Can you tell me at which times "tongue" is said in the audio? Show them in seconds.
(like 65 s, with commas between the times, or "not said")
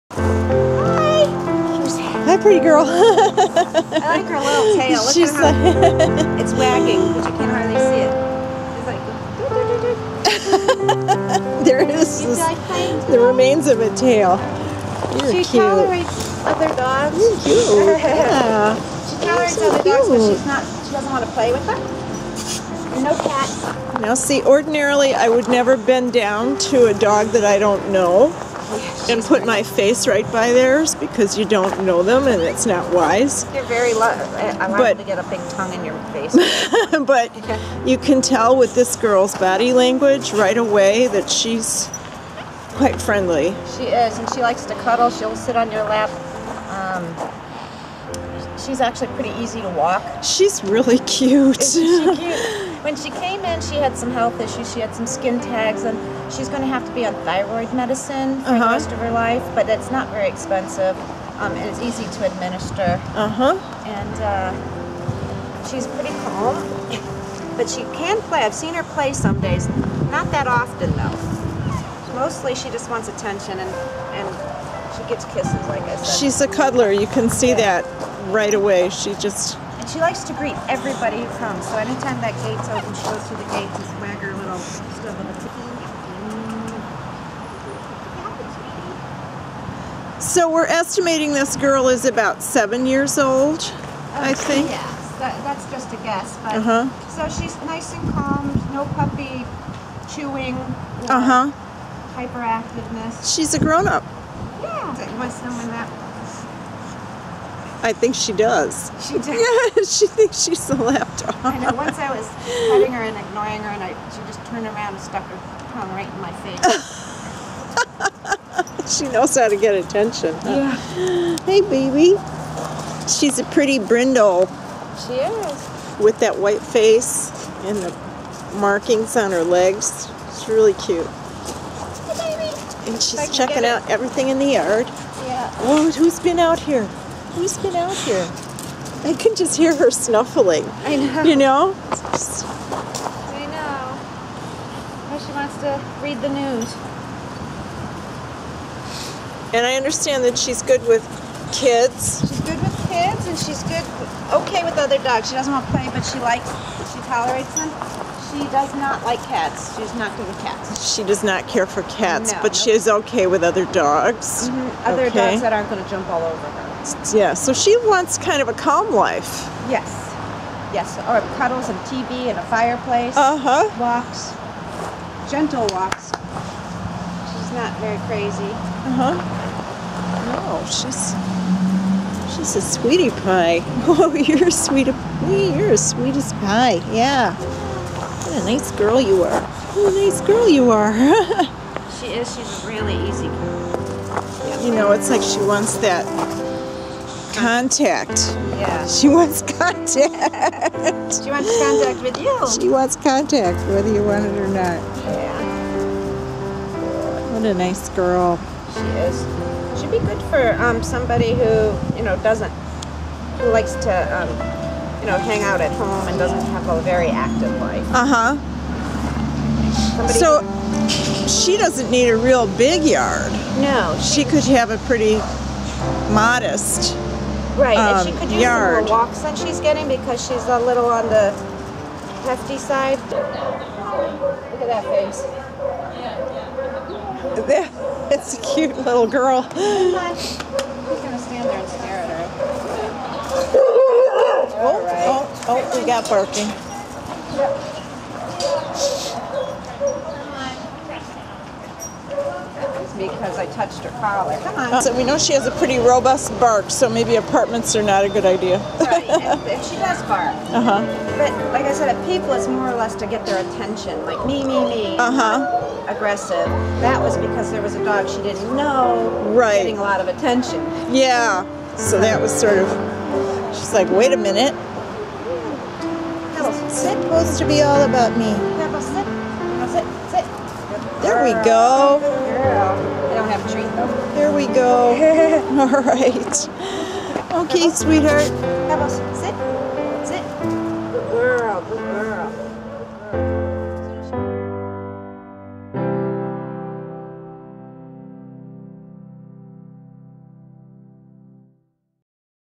35 s, 115 s.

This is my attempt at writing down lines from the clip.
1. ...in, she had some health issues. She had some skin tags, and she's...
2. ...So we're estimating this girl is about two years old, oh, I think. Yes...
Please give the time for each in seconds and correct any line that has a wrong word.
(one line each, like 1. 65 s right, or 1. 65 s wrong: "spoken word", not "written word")
1. 53 s right
2. 90 s wrong: "seven", not "two".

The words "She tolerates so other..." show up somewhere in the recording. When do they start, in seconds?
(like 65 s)
19 s.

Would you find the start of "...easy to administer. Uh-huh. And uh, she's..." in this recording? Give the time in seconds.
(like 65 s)
61 s.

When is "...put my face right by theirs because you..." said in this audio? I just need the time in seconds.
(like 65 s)
29 s.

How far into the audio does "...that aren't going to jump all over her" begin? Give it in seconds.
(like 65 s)
165 s.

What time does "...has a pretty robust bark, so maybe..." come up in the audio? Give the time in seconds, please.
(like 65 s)
255 s.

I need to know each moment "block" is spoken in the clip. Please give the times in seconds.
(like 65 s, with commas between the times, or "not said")
not said.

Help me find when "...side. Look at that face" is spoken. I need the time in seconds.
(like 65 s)
232 s.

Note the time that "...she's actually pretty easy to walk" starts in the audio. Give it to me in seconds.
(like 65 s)
48 s.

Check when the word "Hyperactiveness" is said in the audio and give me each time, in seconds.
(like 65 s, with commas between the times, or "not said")
102 s.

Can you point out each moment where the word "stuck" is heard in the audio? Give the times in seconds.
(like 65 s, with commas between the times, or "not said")
115 s.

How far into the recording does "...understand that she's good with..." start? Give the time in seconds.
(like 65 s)
149 s.